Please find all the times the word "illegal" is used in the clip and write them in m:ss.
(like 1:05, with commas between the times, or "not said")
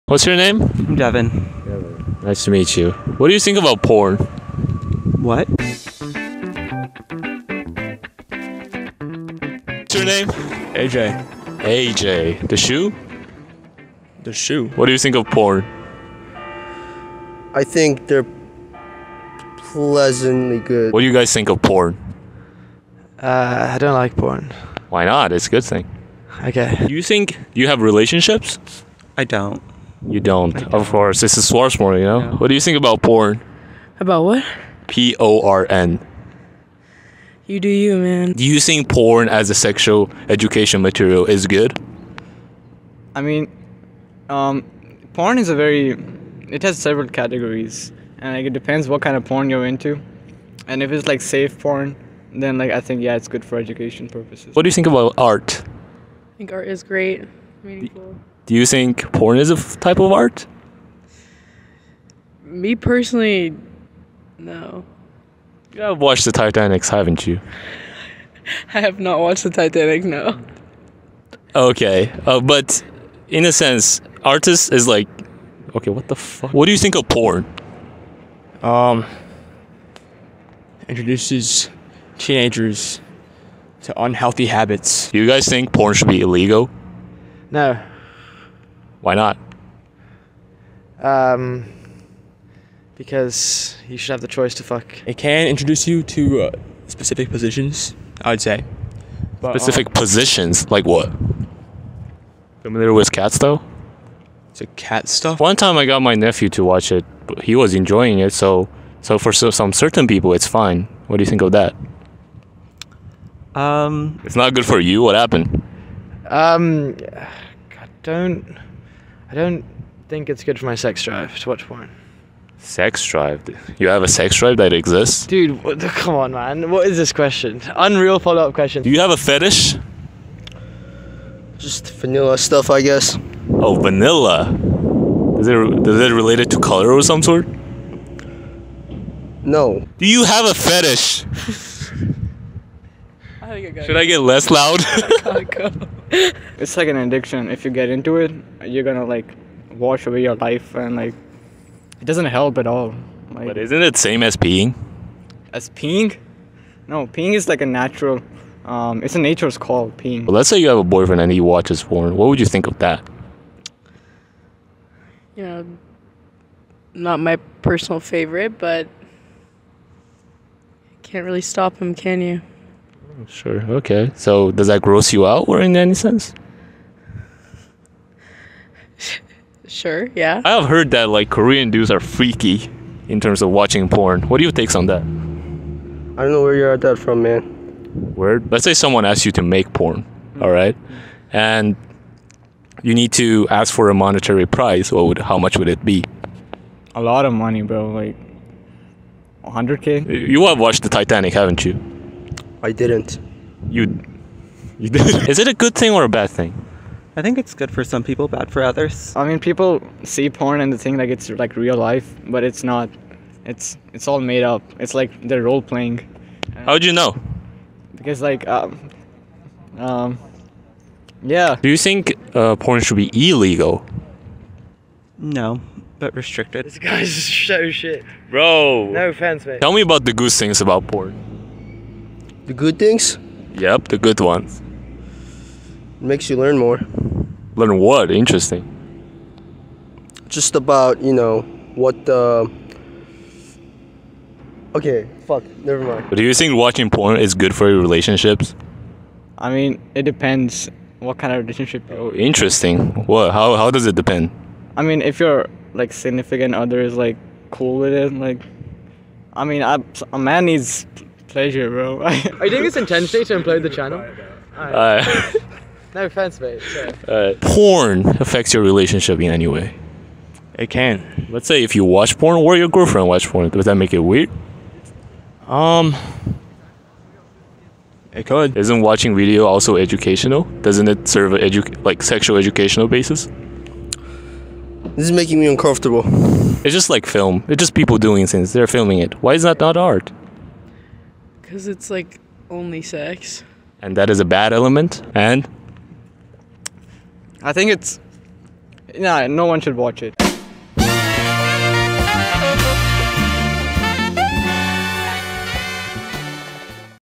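1:26, 3:43.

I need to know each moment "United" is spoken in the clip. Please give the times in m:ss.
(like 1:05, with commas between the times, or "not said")
not said.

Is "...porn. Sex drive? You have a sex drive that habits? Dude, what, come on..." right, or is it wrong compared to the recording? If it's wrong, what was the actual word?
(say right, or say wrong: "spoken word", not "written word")
wrong: "exists", not "habits".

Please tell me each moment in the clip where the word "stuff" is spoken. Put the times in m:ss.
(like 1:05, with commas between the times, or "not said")
1:45, 2:12.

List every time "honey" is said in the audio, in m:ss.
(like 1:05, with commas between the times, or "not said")
not said.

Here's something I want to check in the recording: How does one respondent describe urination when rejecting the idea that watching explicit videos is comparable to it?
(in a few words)
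a nature's call.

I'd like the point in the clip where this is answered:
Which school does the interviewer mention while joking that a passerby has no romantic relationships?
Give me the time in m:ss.
0:31.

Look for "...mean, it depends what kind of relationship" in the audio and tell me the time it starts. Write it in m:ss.
4:09.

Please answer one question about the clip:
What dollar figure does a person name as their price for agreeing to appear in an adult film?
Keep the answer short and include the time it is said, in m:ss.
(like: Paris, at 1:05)
100k, at 3:19.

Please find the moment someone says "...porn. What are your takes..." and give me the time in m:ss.
3:03.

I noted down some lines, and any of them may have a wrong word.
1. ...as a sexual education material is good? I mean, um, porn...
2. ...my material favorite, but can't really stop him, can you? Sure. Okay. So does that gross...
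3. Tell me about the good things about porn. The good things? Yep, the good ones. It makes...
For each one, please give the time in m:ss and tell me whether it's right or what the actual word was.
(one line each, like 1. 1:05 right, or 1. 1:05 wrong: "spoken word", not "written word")
1. 0:39 right
2. 2:47 wrong: "personal", not "material"
3. 3:49 right.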